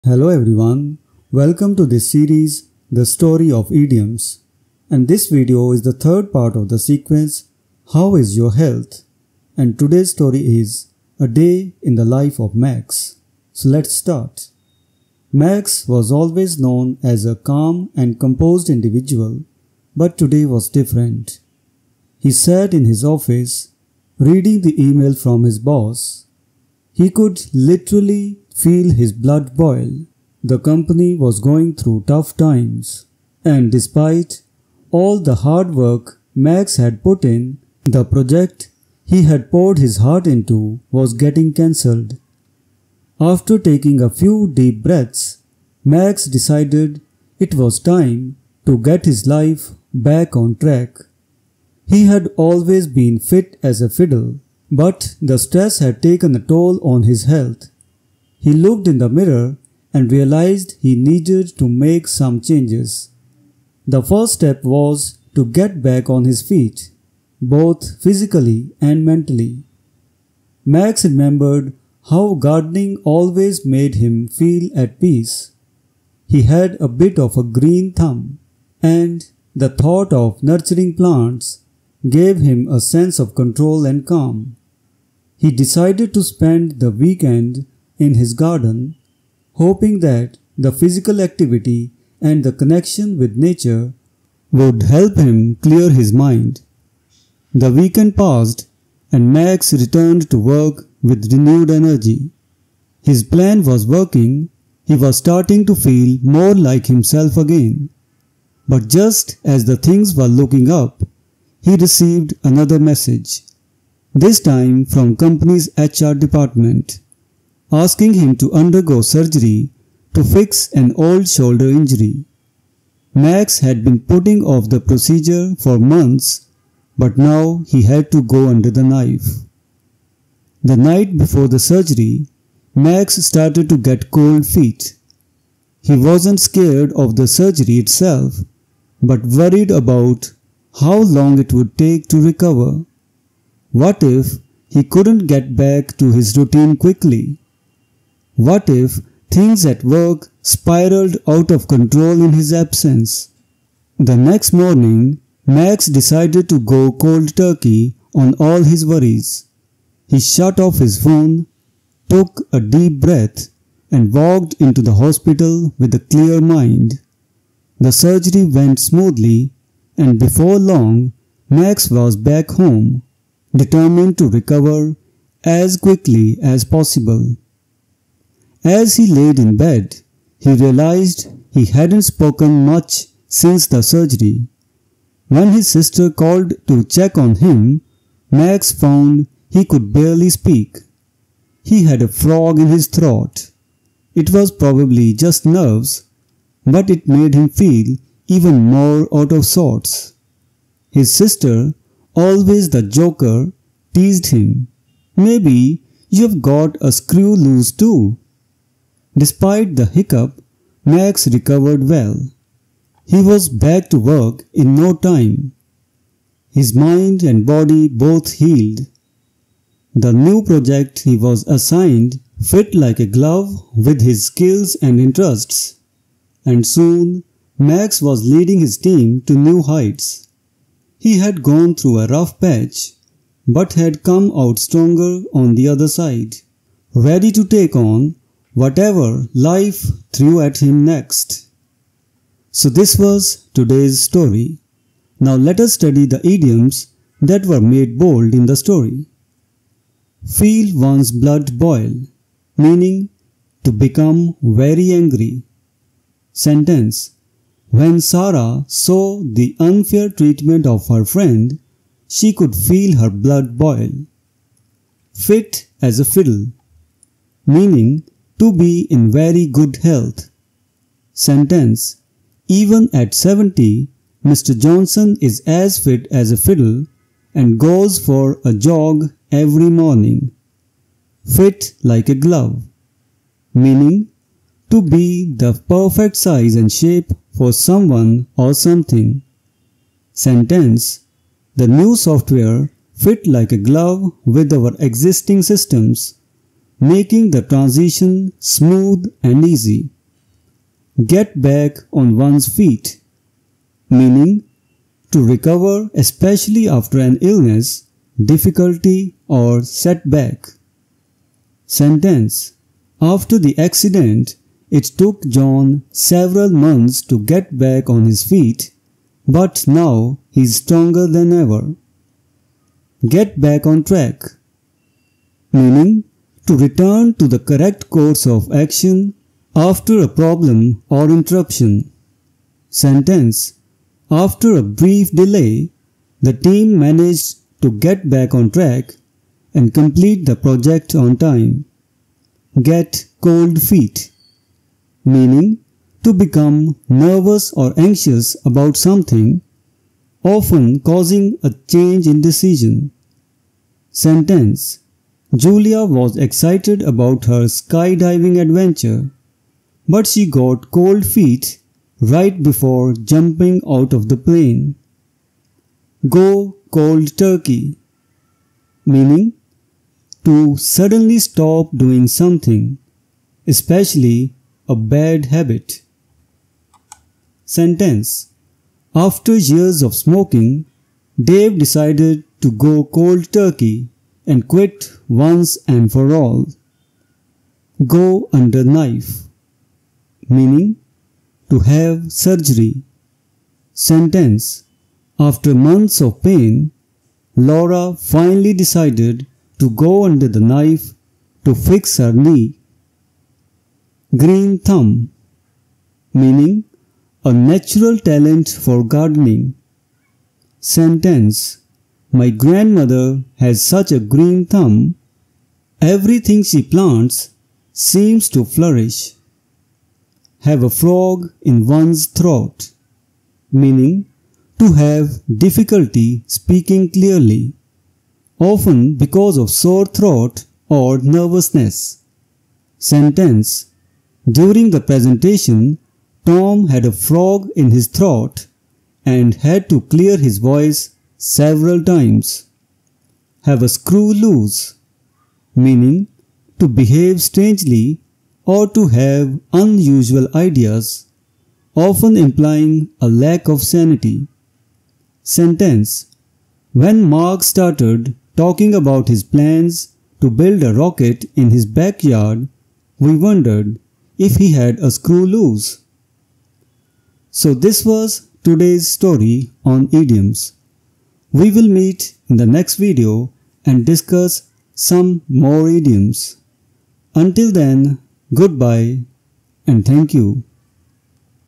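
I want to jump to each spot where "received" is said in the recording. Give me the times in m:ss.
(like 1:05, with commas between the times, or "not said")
1:51.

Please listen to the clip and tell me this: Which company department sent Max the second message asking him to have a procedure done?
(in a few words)
HR.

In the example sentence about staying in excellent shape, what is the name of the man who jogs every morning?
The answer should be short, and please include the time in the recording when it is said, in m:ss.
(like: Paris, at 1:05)
Mr. Johnson, at 4:34.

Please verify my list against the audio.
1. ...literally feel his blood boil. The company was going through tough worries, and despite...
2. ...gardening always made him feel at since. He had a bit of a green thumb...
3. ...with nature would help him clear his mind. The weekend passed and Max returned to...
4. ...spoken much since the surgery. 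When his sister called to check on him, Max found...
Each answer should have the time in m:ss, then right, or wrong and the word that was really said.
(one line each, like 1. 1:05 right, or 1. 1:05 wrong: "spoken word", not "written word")
1. 0:27 wrong: "times", not "worries"
2. 1:12 wrong: "peace", not "since"
3. 1:33 right
4. 3:02 right.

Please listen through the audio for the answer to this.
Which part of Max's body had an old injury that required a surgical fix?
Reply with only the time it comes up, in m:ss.
2:01.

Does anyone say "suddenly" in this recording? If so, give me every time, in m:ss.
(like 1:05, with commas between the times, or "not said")
6:10.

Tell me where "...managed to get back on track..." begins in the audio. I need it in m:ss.
5:36.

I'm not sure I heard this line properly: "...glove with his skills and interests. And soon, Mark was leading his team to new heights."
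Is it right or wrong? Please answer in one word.
wrong.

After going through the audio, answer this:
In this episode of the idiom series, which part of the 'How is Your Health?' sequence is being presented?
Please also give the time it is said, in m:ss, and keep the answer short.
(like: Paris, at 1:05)
third, at 0:05.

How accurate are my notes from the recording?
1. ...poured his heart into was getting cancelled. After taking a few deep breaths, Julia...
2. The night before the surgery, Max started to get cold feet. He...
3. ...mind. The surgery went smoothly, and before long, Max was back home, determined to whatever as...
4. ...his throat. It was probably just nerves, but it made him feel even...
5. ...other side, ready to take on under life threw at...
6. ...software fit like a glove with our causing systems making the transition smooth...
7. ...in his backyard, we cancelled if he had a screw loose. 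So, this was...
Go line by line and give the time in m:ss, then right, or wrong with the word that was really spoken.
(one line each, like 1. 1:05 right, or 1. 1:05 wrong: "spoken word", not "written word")
1. 0:39 wrong: "Max", not "Julia"
2. 2:10 right
3. 2:46 wrong: "recover", not "whatever"
4. 3:12 right
5. 3:55 wrong: "whatever", not "under"
6. 4:51 wrong: "existing", not "causing"
7. 7:41 wrong: "wondered", not "cancelled".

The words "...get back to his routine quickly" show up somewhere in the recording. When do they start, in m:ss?
2:25.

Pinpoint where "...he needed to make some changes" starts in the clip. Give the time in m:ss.
1:00.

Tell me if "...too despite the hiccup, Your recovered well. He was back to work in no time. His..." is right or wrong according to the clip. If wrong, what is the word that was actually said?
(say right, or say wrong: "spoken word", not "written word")
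wrong: "Max", not "Your".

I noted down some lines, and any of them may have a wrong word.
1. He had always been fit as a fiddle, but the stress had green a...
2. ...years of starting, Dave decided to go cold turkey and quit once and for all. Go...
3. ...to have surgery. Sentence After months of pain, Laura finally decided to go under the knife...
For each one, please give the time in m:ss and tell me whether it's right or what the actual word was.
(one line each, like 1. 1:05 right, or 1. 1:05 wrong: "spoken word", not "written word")
1. 0:51 wrong: "taken", not "green"
2. 6:19 wrong: "smoking", not "starting"
3. 6:31 right.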